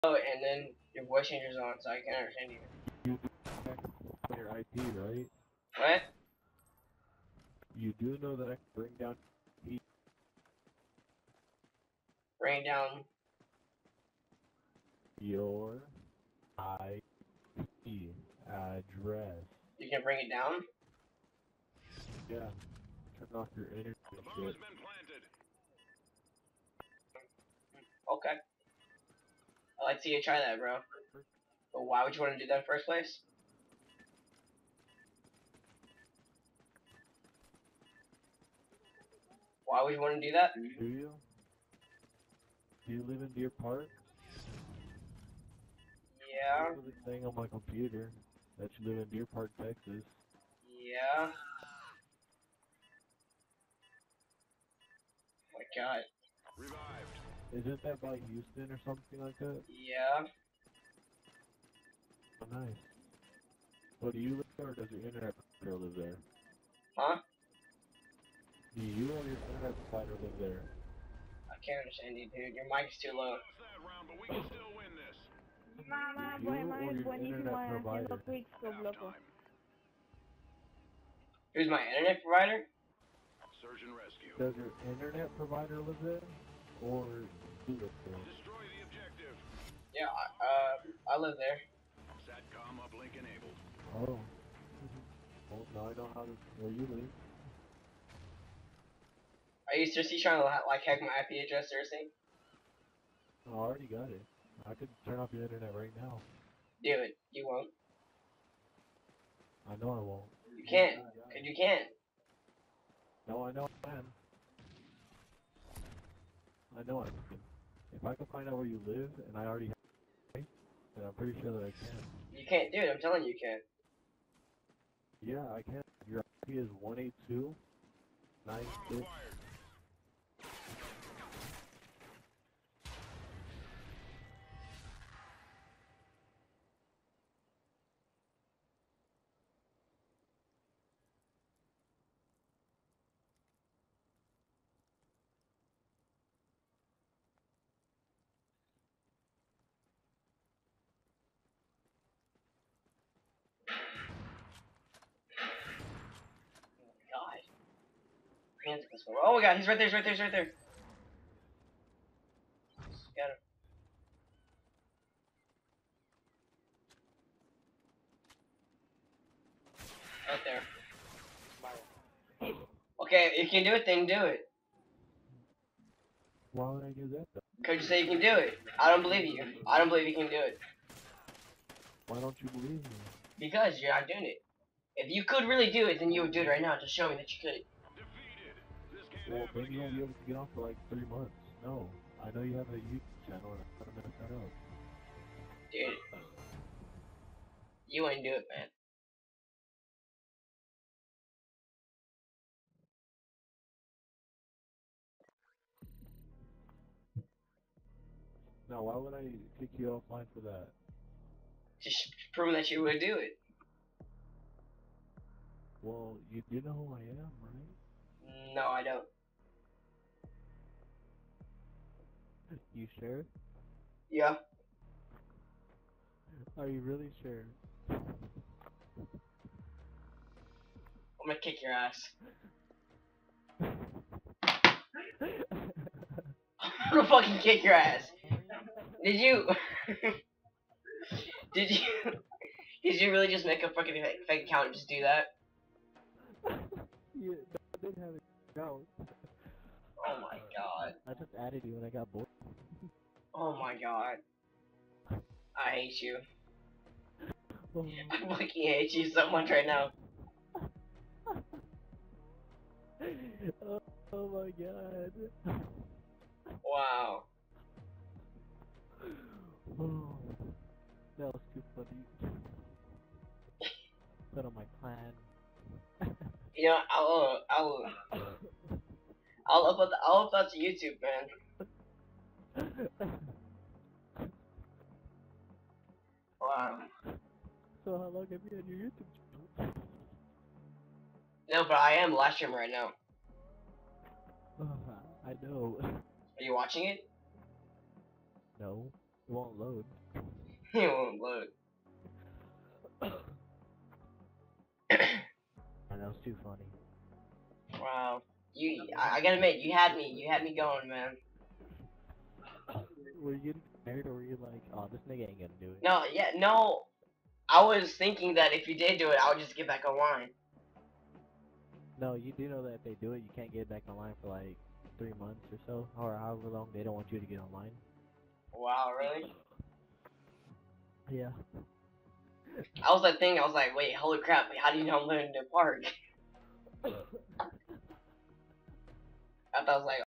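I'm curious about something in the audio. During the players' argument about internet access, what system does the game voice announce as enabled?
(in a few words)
Satcom uplink.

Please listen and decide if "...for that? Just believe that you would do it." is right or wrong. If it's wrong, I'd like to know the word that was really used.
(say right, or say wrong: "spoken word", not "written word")
wrong: "prove", not "believe".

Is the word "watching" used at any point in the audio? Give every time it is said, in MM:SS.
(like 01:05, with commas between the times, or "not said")
04:56.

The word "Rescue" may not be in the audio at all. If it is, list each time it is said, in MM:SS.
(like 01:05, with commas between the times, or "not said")
01:23.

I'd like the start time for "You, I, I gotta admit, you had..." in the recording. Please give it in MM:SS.
05:08.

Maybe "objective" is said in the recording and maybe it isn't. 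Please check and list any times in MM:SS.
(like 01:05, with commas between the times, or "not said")
01:28.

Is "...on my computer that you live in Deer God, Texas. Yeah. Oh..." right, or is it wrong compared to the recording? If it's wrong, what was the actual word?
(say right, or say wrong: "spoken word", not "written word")
wrong: "Park", not "God".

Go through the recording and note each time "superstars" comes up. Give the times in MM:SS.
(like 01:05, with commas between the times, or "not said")
not said.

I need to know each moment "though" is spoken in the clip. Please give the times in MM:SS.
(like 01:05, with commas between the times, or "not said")
02:57.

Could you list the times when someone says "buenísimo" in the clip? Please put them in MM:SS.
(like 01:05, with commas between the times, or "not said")
01:17.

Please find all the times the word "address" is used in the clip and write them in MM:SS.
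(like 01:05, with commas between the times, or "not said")
00:18, 01:41.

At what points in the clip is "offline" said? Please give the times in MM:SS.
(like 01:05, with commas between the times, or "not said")
03:30.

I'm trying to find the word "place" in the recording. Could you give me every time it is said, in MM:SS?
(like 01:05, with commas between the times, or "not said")
00:32.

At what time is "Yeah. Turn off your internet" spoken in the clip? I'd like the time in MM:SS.
00:22.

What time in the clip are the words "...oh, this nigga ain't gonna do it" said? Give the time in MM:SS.
05:14.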